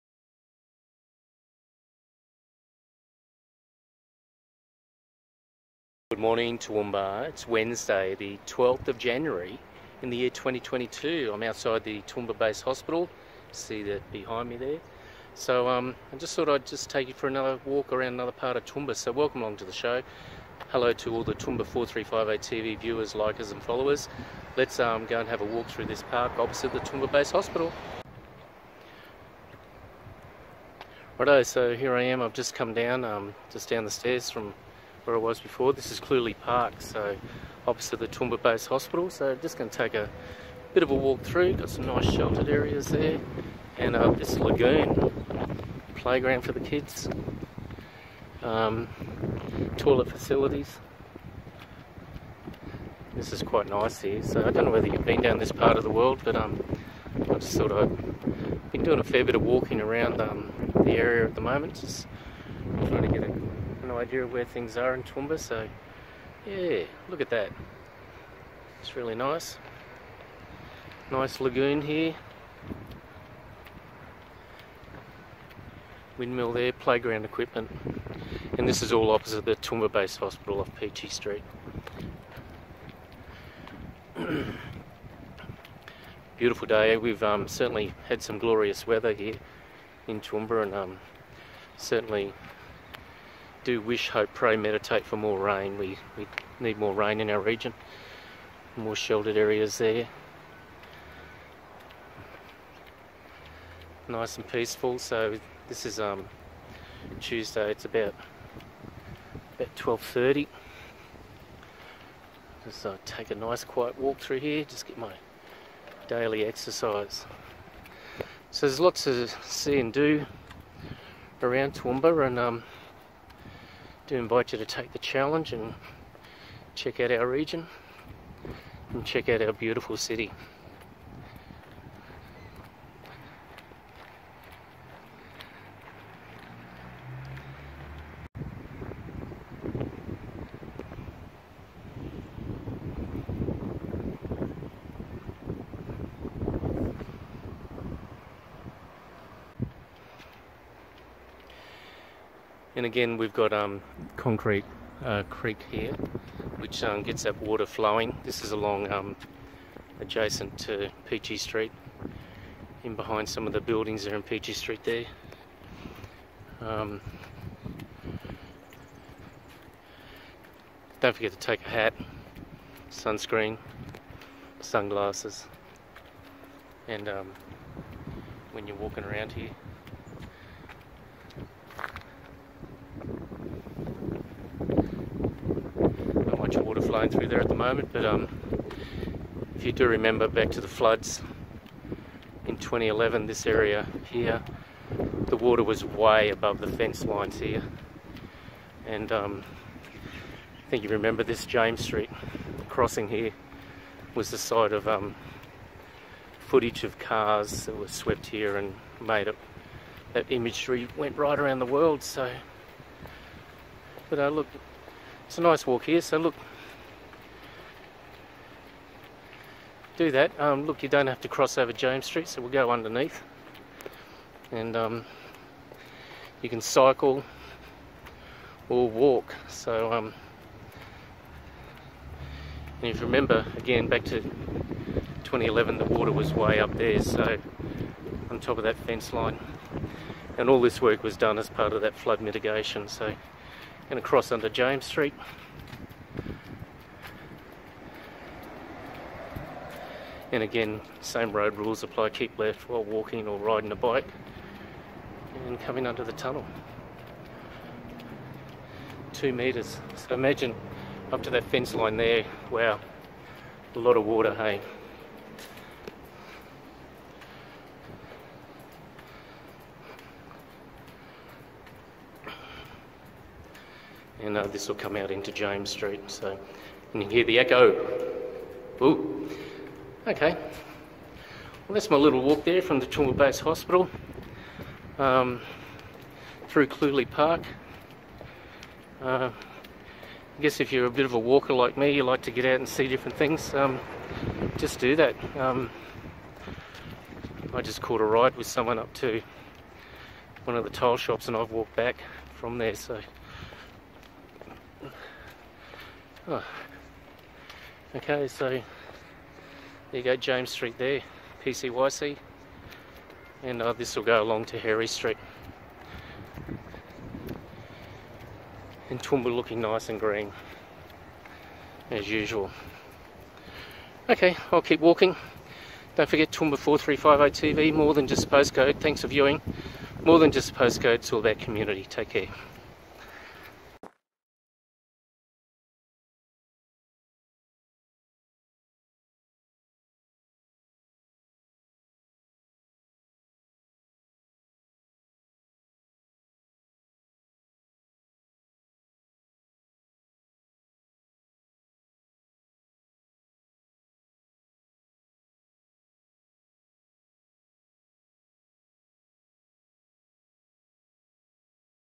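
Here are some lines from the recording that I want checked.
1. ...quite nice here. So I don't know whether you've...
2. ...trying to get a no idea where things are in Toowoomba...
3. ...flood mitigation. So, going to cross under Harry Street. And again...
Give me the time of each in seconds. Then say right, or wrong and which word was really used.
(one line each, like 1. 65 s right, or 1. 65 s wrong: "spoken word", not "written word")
1. 53 s right
2. 62 s right
3. 241 s wrong: "James", not "Harry".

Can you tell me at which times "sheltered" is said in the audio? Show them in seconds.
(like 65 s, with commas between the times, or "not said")
42 s, 98 s.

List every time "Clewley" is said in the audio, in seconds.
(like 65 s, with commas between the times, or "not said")
35 s, 286 s.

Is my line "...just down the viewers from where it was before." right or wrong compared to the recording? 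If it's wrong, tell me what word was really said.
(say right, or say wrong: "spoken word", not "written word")
wrong: "stairs", not "viewers".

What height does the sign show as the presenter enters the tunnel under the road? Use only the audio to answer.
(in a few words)
2 metres.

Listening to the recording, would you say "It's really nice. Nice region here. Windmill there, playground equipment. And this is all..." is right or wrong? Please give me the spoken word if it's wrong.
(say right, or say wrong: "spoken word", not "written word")
wrong: "lagoon", not "region".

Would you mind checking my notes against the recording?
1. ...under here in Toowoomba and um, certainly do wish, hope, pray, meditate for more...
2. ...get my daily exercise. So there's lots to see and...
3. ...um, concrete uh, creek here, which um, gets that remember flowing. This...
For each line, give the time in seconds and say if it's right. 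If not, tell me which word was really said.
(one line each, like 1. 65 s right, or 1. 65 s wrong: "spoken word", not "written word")
1. 88 s wrong: "weather", not "under"
2. 114 s right
3. 153 s wrong: "water", not "remember".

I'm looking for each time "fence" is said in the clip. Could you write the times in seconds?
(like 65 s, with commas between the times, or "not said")
196 s, 238 s, 261 s.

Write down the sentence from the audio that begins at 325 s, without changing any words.
Don't forget Toowoomba 4350 TV, more than just postcode.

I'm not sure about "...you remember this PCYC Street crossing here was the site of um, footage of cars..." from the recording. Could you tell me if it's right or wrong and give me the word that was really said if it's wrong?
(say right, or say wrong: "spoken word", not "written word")
wrong: "James", not "PCYC".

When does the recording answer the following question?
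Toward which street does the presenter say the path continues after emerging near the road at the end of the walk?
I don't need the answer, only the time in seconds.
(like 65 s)
314 s.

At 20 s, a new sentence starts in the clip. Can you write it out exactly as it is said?
Hello to all the Toowoomba 4358 TV viewers, likers and followers.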